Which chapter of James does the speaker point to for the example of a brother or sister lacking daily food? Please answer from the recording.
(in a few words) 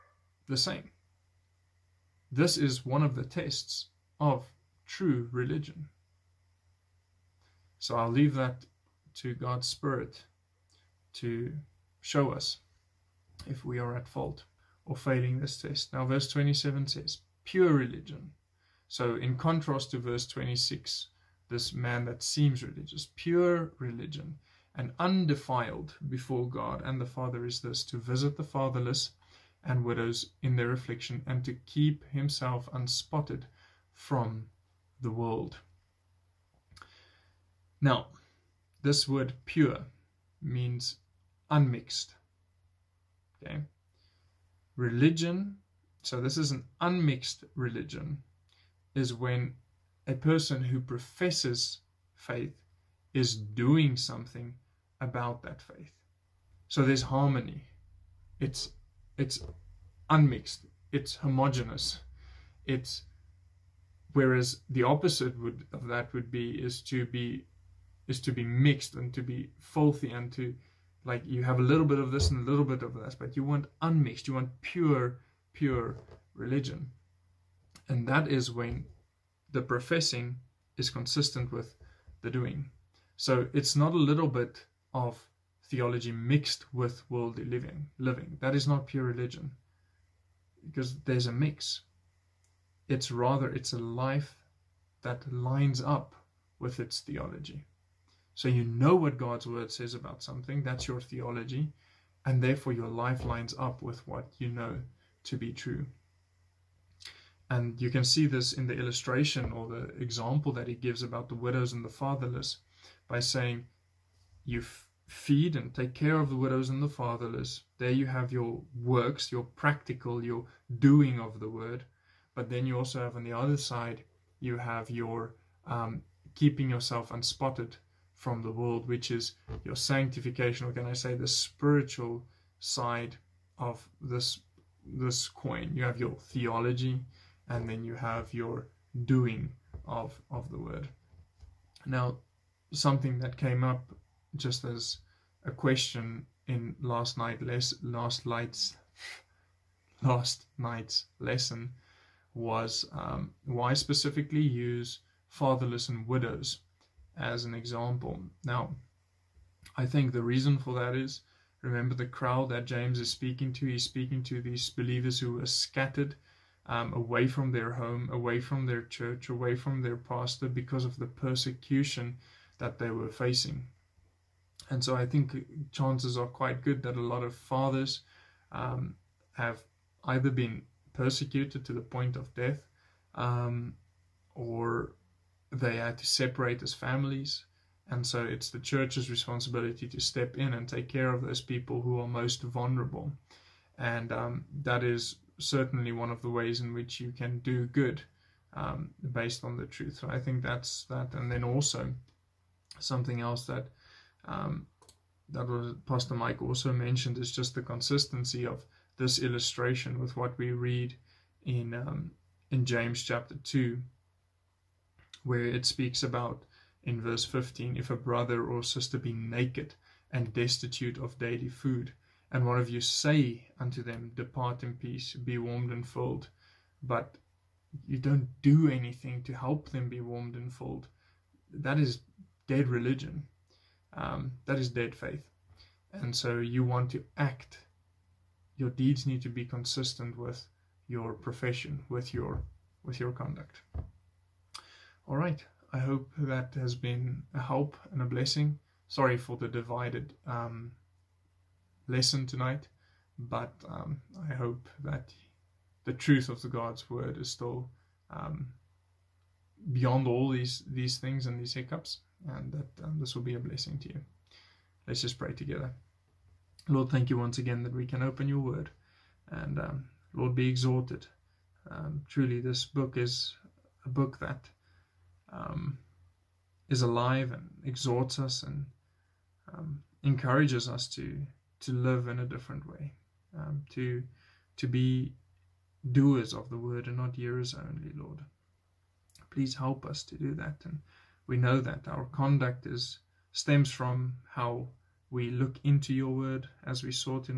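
chapter 2.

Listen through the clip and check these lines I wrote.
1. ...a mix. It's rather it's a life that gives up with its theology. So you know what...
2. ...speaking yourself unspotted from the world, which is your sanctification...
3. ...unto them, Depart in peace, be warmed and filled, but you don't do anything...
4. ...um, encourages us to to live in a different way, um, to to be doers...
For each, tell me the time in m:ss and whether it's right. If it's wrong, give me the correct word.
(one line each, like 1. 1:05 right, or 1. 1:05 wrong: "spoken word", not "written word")
1. 1:31 wrong: "lines", not "gives"
2. 2:06 wrong: "keeping", not "speaking"
3. 3:43 right
4. 4:39 right.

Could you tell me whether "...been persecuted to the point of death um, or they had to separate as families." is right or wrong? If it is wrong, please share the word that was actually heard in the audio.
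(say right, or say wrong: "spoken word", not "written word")
right.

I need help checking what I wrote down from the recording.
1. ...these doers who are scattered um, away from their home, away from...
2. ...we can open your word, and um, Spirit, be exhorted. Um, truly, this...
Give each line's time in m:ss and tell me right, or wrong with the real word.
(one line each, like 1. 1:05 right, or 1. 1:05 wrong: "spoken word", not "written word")
1. 2:44 wrong: "believers", not "doers"
2. 4:27 wrong: "Lord", not "Spirit".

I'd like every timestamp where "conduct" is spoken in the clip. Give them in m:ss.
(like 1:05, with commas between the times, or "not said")
4:03, 4:52.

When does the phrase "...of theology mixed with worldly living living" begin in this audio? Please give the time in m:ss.
1:24.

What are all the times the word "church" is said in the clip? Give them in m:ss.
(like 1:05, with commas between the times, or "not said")
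2:48, 3:08.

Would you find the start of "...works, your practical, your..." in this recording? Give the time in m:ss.
1:58.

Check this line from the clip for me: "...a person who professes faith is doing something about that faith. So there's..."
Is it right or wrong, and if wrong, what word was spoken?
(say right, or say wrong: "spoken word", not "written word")
right.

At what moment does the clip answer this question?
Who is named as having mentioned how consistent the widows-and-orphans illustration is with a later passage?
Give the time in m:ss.
3:25.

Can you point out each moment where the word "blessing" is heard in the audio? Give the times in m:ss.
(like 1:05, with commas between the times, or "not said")
4:08, 4:23.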